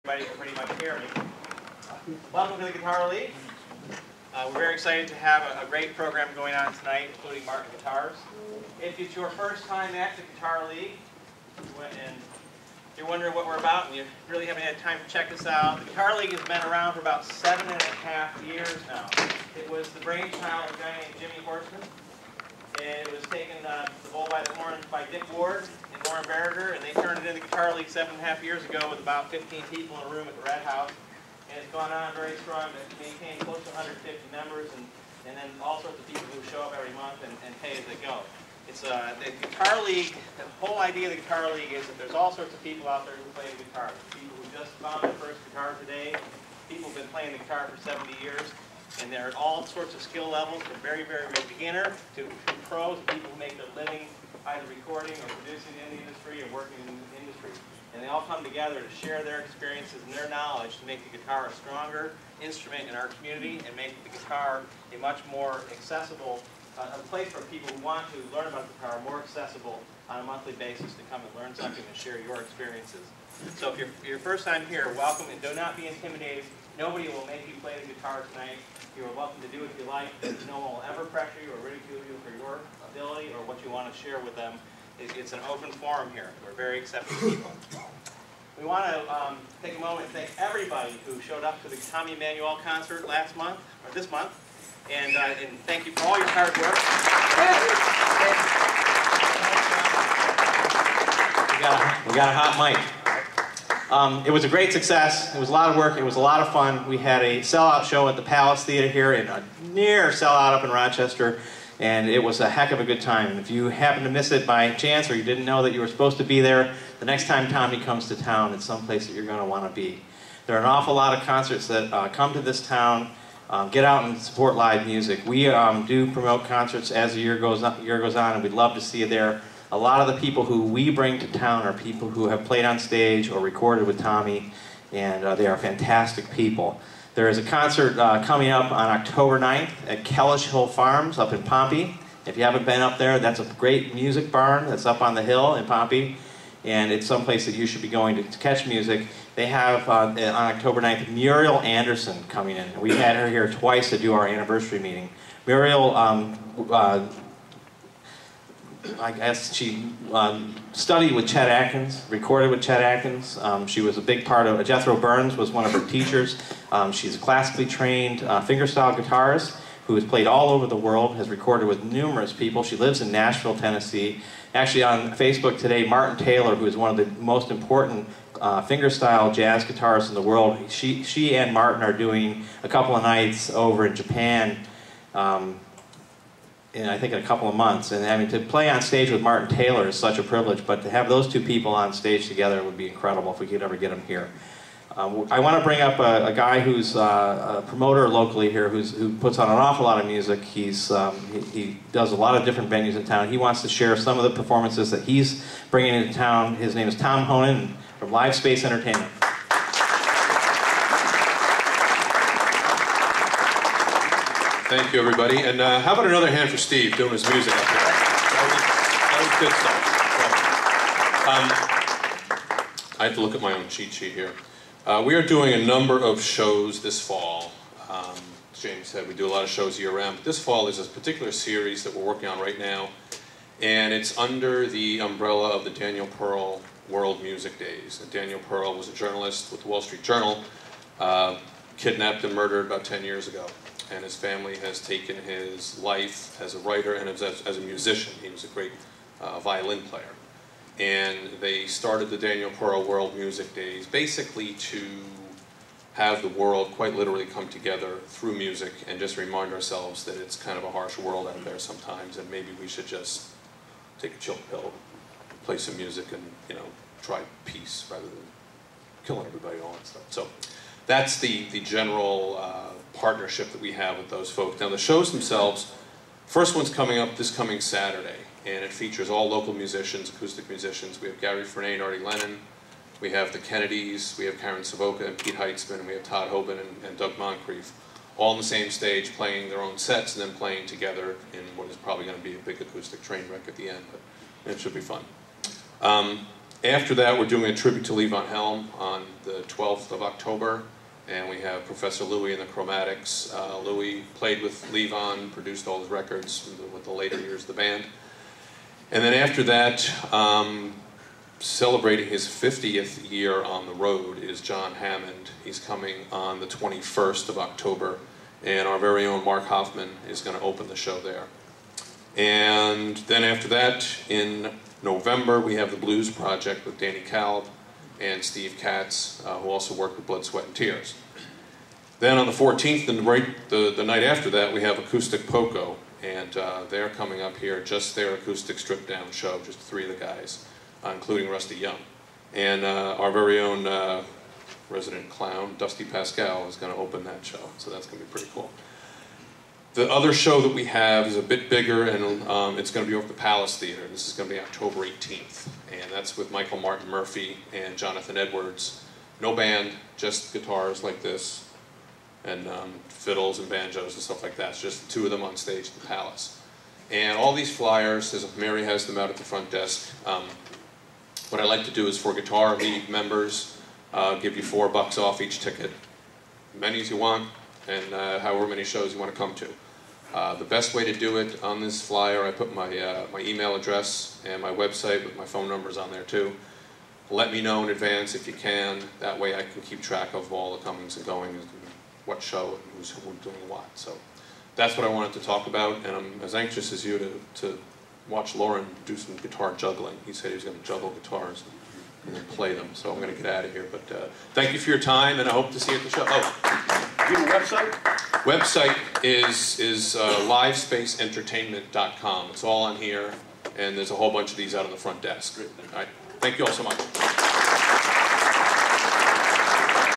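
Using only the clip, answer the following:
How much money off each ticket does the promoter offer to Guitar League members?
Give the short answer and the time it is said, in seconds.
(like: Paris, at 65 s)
$4, at 374 s.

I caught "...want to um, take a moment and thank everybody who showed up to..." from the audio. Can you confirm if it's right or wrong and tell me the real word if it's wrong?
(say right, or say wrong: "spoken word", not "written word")
right.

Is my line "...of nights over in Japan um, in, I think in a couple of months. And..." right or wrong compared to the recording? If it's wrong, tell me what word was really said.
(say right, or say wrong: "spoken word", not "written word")
right.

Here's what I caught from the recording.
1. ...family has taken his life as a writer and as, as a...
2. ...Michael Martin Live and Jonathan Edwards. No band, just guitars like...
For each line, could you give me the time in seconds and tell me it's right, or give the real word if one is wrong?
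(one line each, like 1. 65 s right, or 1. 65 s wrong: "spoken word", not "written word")
1. 244 s right
2. 356 s wrong: "Murphey", not "Live".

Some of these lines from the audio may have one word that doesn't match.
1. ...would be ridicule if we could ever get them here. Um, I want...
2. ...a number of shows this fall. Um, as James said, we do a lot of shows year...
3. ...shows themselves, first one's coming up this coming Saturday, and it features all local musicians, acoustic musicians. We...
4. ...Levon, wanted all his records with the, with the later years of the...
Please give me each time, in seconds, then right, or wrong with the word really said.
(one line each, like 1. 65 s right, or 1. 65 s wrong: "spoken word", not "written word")
1. 192 s wrong: "incredible", not "ridicule"
2. 225 s right
3. 274 s right
4. 304 s wrong: "produced", not "wanted".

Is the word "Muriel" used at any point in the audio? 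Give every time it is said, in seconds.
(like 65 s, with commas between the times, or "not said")
151 s, 155 s.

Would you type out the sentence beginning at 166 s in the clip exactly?
Um, she's a classically trained uh, fingerstyle guitarist who has played all over the world, has recorded with numerous people.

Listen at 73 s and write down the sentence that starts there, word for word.
So if you're your first time here, welcome and do not be intimidated Nobody will make you play the guitar tonight.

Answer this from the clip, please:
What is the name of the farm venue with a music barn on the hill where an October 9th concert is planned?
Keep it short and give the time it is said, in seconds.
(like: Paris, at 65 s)
Kellish Hill Farms, at 140 s.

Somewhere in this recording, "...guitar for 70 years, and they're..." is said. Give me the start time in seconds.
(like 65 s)
47 s.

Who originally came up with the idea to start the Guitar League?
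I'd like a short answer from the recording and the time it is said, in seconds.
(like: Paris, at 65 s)
Jimmy Horseman, at 21 s.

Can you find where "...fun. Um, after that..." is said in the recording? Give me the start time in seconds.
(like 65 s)
294 s.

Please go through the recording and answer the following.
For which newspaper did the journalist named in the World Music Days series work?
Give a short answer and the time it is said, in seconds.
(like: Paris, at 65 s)
Wall Street Journal, at 239 s.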